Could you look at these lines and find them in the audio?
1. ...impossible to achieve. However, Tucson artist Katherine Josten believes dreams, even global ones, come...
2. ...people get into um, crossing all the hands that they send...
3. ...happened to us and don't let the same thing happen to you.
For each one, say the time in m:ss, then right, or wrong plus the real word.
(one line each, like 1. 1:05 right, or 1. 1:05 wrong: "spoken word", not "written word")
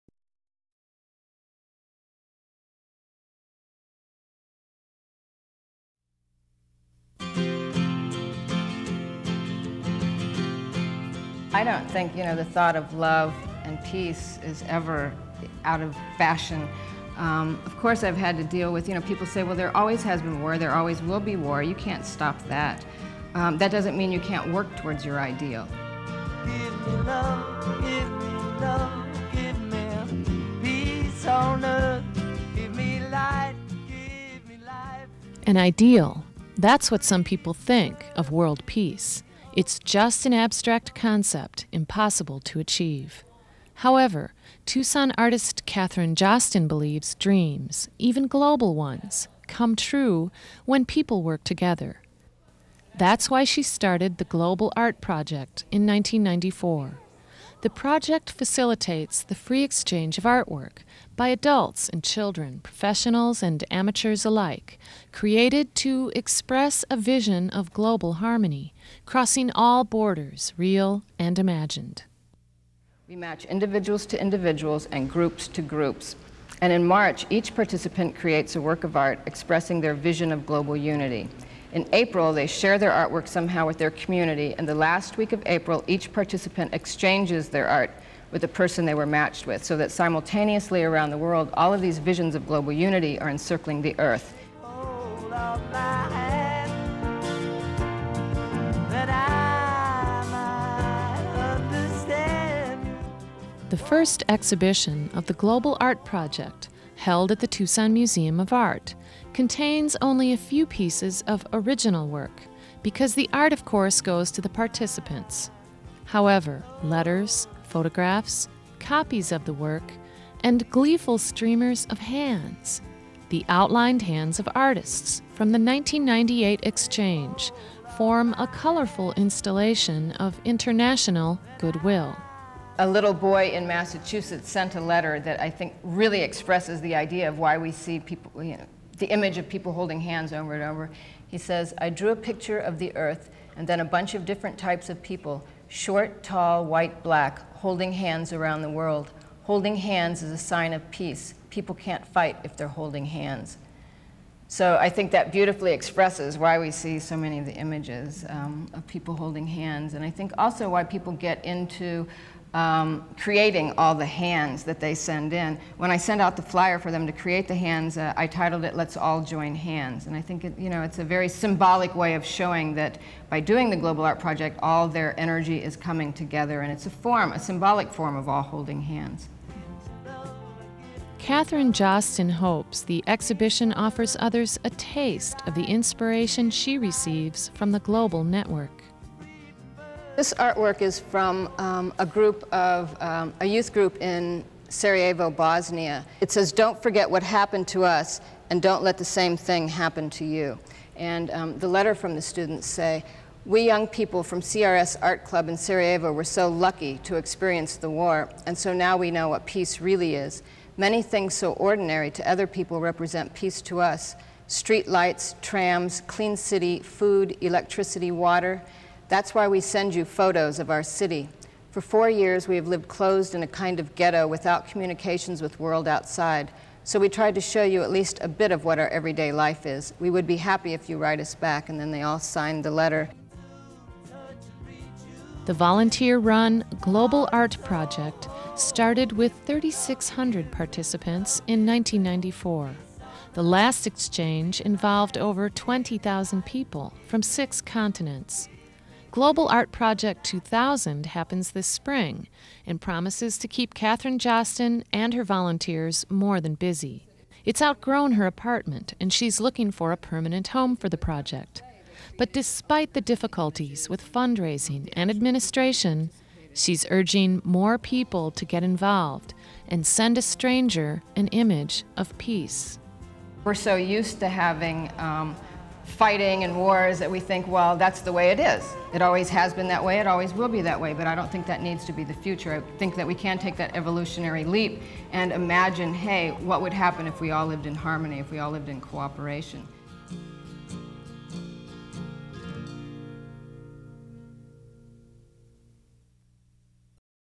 1. 0:41 right
2. 2:40 wrong: "creating", not "crossing"
3. 3:17 right.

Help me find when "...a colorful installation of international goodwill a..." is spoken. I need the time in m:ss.
2:08.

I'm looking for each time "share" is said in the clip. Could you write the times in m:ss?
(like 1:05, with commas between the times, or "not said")
1:22.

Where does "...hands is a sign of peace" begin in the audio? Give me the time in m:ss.
2:29.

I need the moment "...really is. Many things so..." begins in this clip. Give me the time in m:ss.
3:29.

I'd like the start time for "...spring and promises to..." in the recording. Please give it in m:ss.
4:11.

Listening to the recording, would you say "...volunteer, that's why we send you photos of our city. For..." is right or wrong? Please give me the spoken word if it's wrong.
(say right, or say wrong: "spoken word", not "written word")
wrong: "water", not "volunteer".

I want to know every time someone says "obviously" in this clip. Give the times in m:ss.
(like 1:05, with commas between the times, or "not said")
not said.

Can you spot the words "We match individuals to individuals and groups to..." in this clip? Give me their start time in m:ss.
1:13.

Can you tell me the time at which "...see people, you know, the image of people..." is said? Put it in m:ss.
2:17.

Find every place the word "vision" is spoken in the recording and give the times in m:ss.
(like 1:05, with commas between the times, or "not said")
1:06, 1:19, 1:31.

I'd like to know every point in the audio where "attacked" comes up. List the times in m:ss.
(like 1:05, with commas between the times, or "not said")
not said.